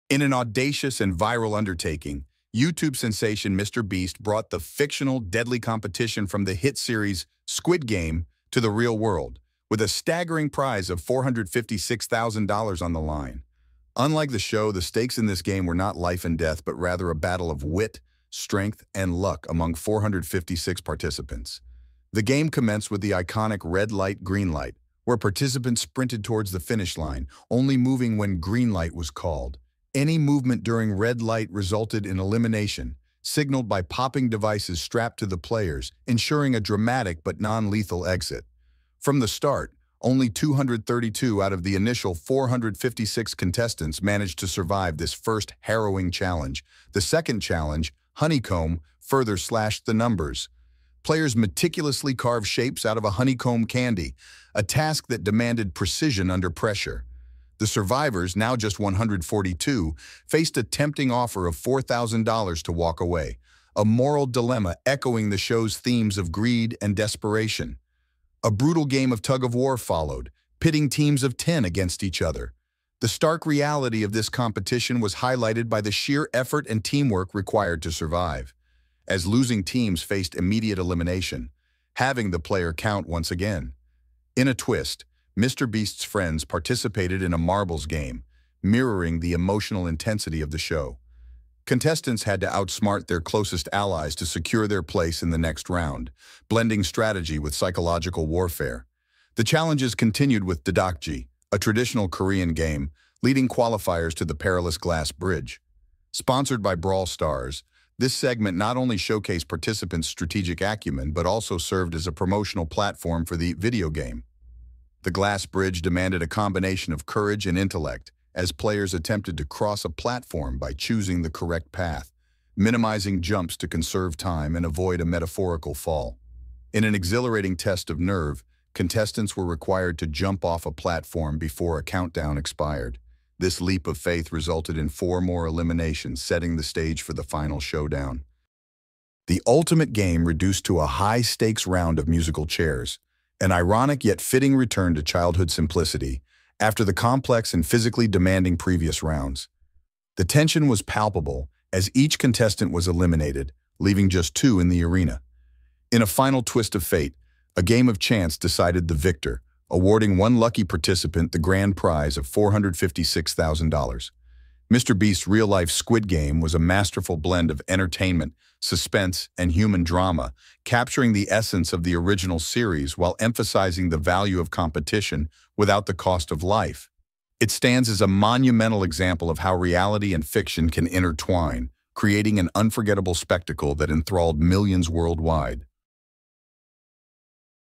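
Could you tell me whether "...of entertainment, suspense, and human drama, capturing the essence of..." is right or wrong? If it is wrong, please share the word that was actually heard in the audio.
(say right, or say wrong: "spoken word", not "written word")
right.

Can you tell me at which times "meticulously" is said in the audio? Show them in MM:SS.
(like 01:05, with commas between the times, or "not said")
00:51.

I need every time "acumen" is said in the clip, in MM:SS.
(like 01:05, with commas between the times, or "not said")
01:50.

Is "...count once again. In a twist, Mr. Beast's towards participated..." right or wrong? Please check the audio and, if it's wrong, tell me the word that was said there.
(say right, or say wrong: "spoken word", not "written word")
wrong: "friends", not "towards".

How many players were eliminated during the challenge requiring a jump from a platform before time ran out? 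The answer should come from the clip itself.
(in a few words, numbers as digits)
4.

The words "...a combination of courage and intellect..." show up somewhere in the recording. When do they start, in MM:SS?
01:56.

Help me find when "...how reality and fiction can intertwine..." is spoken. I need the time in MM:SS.
02:59.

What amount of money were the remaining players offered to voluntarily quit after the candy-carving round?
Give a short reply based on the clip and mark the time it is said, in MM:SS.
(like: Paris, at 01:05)
$4,000, at 01:01.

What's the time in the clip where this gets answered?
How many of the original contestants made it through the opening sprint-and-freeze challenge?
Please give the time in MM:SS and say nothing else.
00:40.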